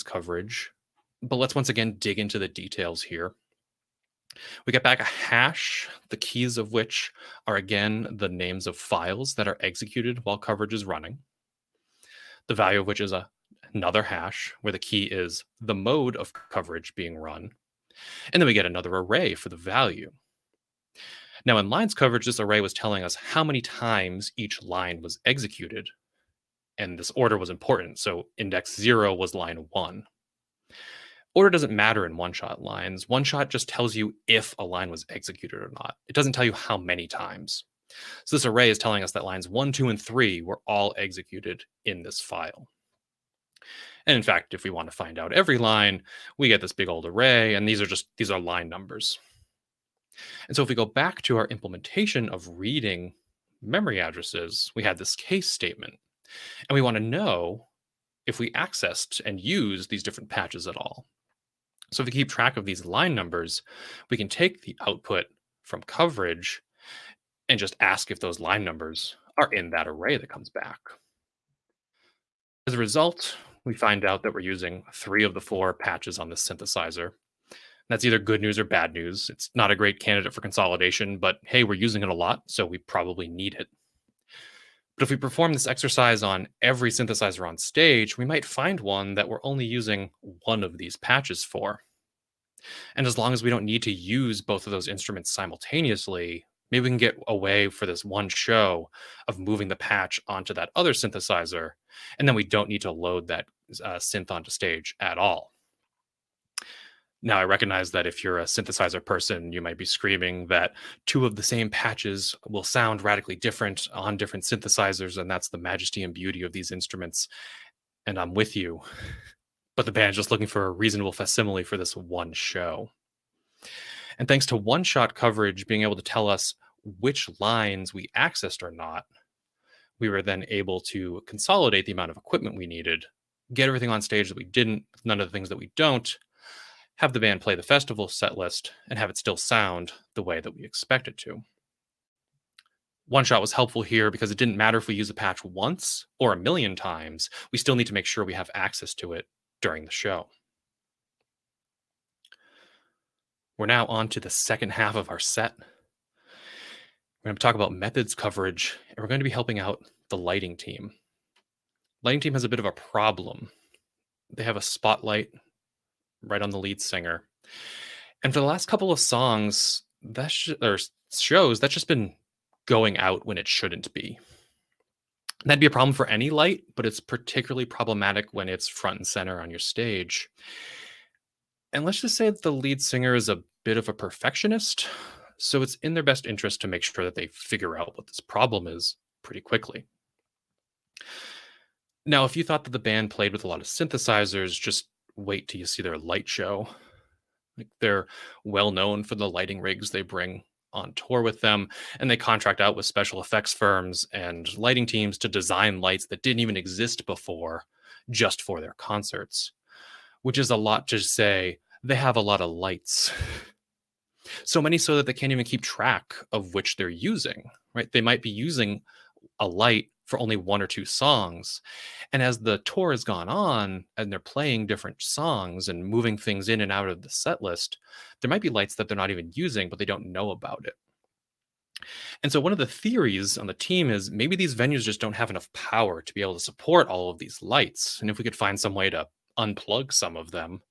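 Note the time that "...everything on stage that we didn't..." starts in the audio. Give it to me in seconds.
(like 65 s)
133 s.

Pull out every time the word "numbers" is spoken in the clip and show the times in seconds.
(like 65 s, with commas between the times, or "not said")
48 s, 63 s, 68 s.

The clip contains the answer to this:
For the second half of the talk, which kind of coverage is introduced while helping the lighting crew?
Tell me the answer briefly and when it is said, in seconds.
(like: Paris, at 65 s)
methods coverage, at 157 s.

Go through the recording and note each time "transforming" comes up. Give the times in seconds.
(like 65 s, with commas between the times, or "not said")
not said.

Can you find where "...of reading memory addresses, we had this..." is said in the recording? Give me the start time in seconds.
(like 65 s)
52 s.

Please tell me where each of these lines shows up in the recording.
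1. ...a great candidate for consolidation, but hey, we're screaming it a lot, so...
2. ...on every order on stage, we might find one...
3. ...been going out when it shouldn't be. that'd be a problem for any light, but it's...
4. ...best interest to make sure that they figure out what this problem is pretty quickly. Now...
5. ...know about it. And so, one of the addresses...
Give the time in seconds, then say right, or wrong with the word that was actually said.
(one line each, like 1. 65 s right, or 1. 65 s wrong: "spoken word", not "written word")
1. 79 s wrong: "using", not "screaming"
2. 86 s wrong: "synthesizer", not "order"
3. 171 s right
4. 186 s right
5. 230 s wrong: "theories", not "addresses".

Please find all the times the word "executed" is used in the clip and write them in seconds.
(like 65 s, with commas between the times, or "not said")
9 s, 25 s, 35 s, 40 s.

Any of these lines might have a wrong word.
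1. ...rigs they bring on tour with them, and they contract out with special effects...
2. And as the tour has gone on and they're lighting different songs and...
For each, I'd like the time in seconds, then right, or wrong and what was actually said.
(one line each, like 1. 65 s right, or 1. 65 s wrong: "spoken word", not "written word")
1. 199 s right
2. 222 s wrong: "playing", not "lighting".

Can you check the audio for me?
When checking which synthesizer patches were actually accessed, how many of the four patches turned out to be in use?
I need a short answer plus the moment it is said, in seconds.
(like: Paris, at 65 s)
3, at 74 s.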